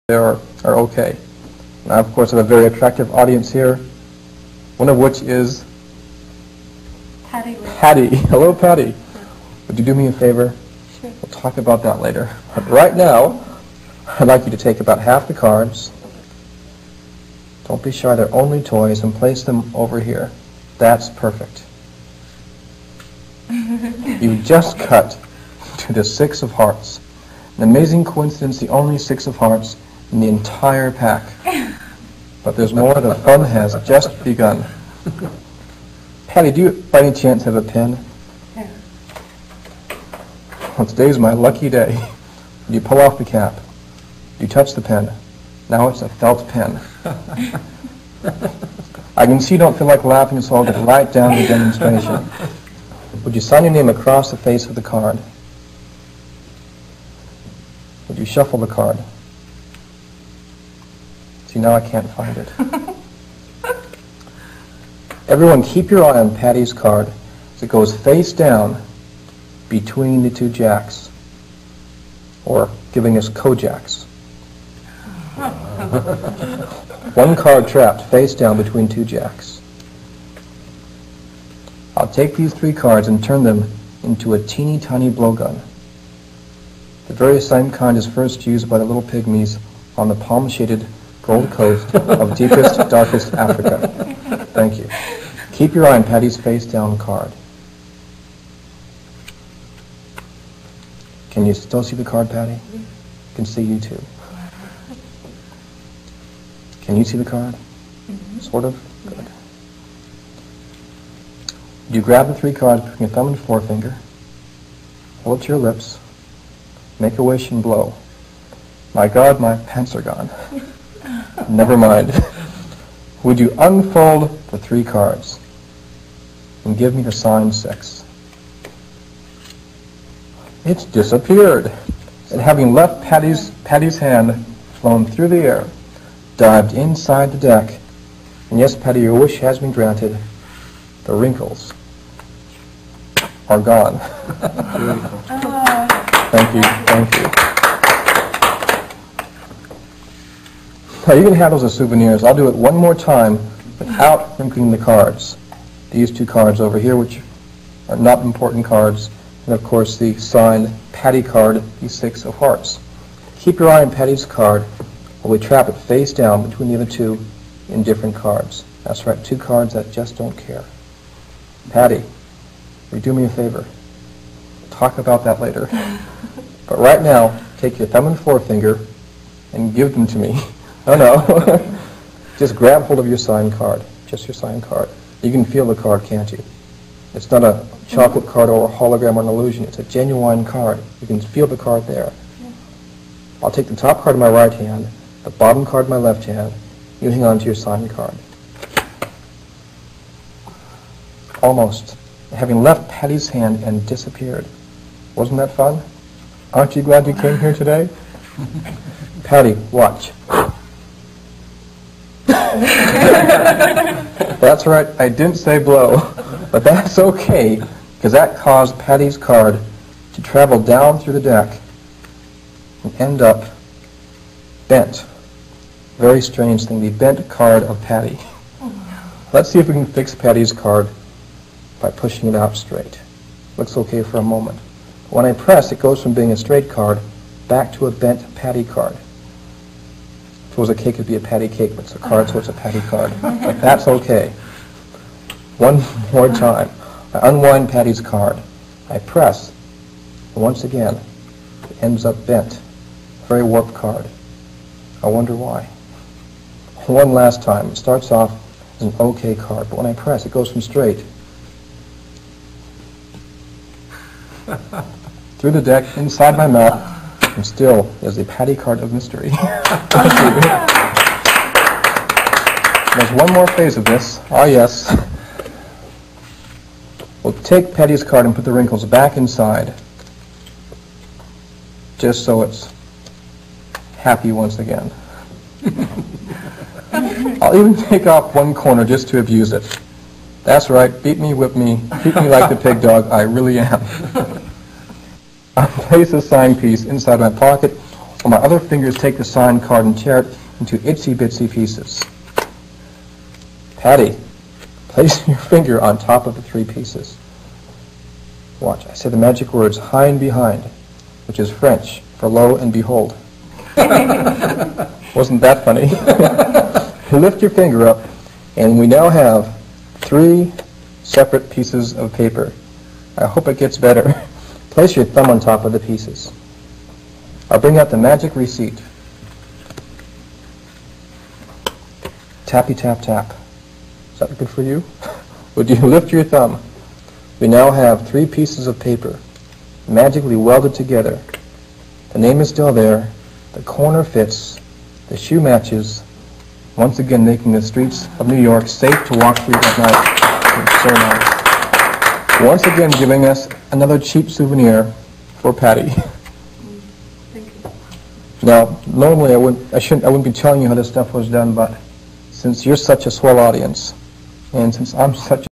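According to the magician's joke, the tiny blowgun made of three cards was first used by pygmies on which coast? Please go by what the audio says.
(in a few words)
Gold Coast.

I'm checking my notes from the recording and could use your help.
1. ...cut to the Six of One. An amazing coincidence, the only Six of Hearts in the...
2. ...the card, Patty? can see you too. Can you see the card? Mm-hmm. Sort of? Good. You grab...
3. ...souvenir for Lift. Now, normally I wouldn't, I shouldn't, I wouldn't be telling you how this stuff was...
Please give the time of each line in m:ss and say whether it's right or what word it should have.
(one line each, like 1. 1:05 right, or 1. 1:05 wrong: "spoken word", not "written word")
1. 0:24 wrong: "Hearts", not "One"
2. 1:41 right
3. 5:54 wrong: "Patty", not "Lift".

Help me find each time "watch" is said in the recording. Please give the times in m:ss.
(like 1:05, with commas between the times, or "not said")
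3:29, 5:08.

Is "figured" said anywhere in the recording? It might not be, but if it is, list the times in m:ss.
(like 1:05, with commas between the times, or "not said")
not said.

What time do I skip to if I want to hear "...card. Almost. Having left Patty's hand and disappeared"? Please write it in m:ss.
3:17.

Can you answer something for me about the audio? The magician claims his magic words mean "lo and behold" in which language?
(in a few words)
French.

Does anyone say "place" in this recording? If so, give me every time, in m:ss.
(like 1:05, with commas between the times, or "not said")
0:19, 4:55, 5:04, 5:24.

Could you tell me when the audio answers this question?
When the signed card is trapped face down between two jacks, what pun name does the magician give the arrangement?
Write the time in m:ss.
1:13.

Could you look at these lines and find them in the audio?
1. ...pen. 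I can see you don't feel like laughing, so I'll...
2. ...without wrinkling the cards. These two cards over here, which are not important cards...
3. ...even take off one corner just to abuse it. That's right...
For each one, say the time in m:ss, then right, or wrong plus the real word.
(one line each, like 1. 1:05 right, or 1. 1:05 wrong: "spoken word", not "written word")
1. 0:46 right
2. 2:33 right
3. 4:47 right.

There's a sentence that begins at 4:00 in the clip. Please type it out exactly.
Suppose a cake would be a patty cake, but it's a card, so it's a patty card.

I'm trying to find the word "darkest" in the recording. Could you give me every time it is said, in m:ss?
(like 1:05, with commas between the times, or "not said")
1:32.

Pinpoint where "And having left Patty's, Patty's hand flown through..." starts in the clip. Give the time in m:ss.
2:12.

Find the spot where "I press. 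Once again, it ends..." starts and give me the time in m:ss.
4:08.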